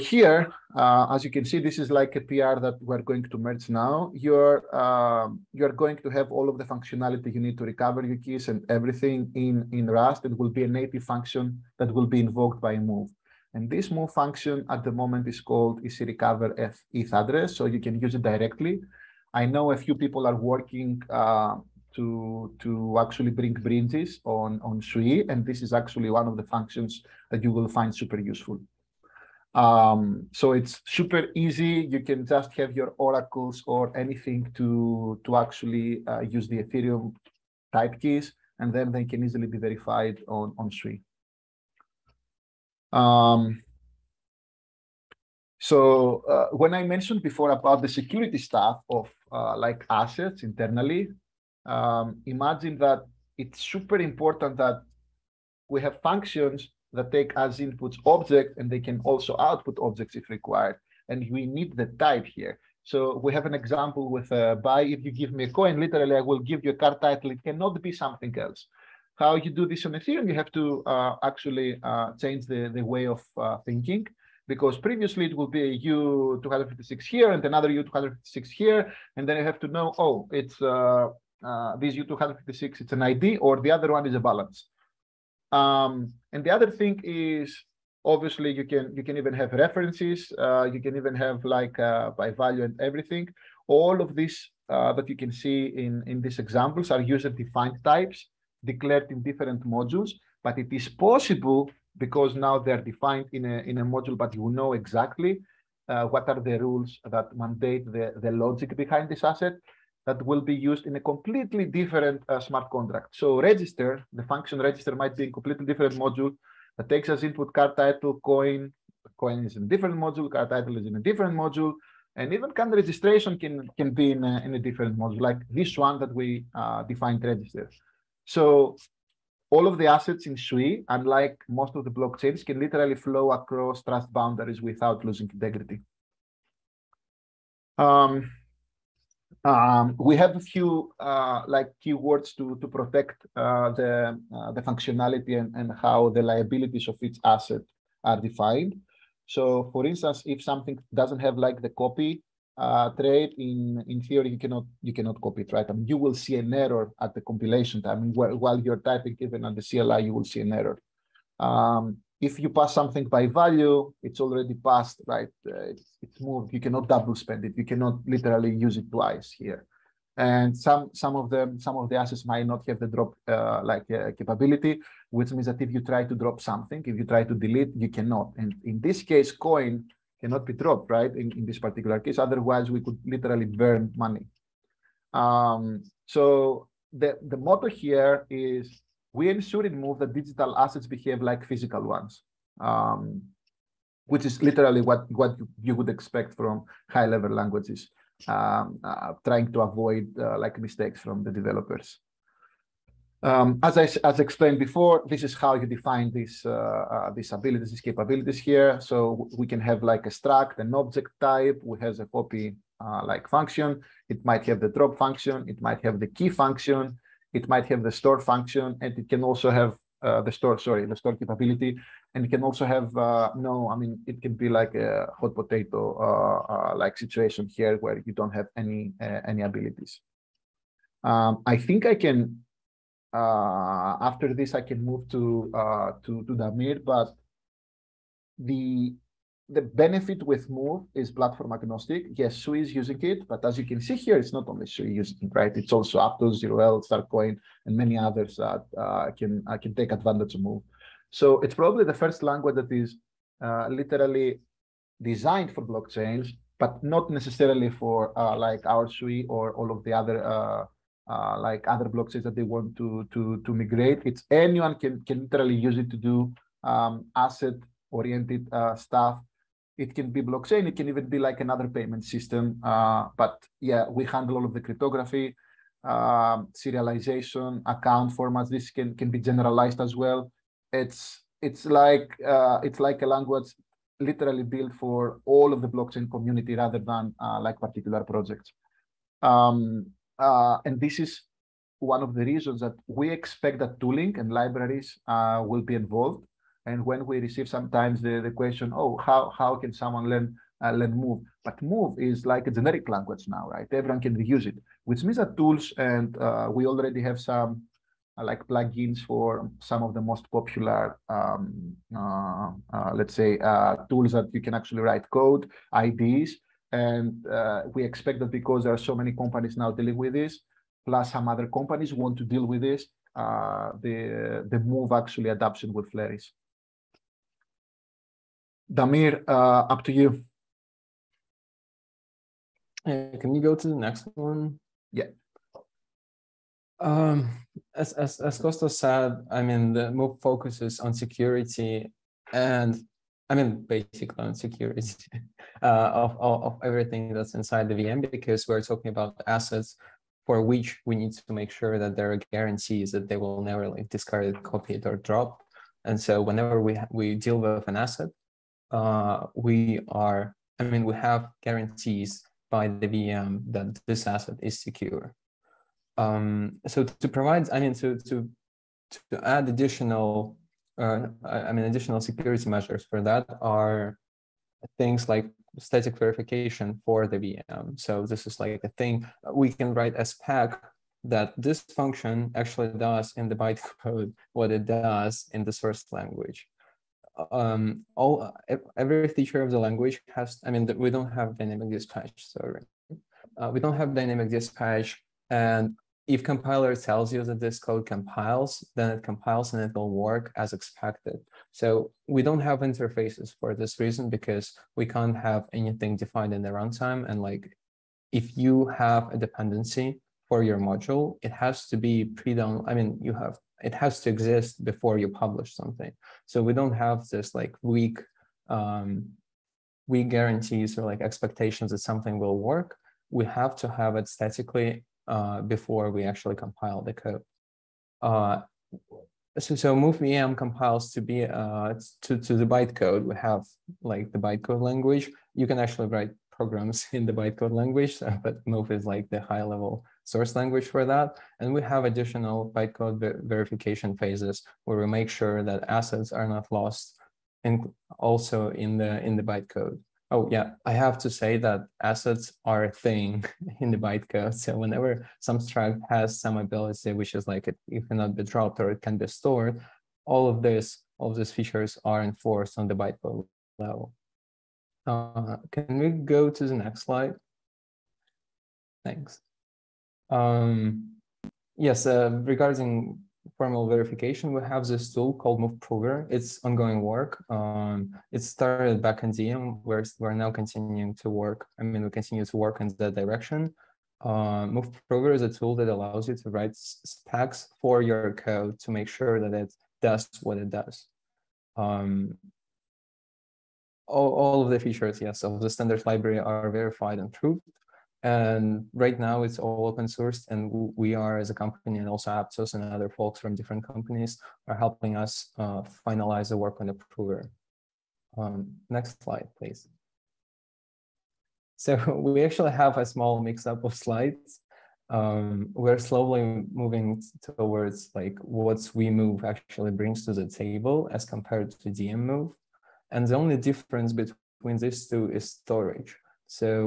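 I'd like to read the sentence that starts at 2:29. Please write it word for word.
So for instance, if something doesn't have like the copy uh, trade in, in theory, you cannot, you cannot copy it, right?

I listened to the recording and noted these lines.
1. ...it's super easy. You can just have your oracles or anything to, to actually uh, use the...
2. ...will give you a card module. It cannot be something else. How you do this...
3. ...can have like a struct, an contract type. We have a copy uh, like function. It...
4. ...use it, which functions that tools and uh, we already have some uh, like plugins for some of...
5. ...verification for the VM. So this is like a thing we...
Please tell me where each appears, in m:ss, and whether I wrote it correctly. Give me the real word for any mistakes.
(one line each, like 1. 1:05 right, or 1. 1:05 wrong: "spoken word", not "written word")
1. 0:30 right
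2. 1:06 wrong: "title", not "module"
3. 3:29 wrong: "object", not "contract"
4. 5:04 wrong: "means", not "functions"
5. 6:15 right.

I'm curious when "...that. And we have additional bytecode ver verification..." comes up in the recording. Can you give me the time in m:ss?
7:20.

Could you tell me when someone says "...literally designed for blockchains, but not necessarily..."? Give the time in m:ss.
4:13.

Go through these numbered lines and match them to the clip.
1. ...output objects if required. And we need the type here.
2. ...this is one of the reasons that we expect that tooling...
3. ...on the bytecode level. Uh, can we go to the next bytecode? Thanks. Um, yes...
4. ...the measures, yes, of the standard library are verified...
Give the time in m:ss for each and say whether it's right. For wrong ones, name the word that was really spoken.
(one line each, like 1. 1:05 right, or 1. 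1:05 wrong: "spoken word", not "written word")
1. 0:59 right
2. 4:50 right
3. 7:42 wrong: "slide", not "bytecode"
4. 8:14 wrong: "features", not "measures".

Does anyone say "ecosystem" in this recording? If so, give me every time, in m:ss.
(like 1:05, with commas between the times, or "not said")
not said.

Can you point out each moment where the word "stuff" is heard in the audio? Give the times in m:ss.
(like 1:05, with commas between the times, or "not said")
0:48, 4:28.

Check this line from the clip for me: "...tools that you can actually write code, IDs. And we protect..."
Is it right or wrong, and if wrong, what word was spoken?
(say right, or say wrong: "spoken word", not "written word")
wrong: "expect", not "protect".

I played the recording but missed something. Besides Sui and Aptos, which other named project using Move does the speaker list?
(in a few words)
Starcoin.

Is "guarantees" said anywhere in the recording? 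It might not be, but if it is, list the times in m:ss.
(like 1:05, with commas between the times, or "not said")
5:52, 6:01, 7:00.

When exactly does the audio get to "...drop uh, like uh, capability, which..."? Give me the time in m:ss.
2:52.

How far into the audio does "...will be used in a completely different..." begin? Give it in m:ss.
1:50.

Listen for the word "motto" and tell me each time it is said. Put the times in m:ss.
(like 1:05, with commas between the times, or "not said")
3:07.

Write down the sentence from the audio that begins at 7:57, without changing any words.
Um, it started back in Xenium, where we're now continuing to work.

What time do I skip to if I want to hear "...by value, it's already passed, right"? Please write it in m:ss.
2:43.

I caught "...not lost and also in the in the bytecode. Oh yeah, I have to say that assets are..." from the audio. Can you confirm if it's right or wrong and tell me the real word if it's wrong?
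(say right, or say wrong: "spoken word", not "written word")
right.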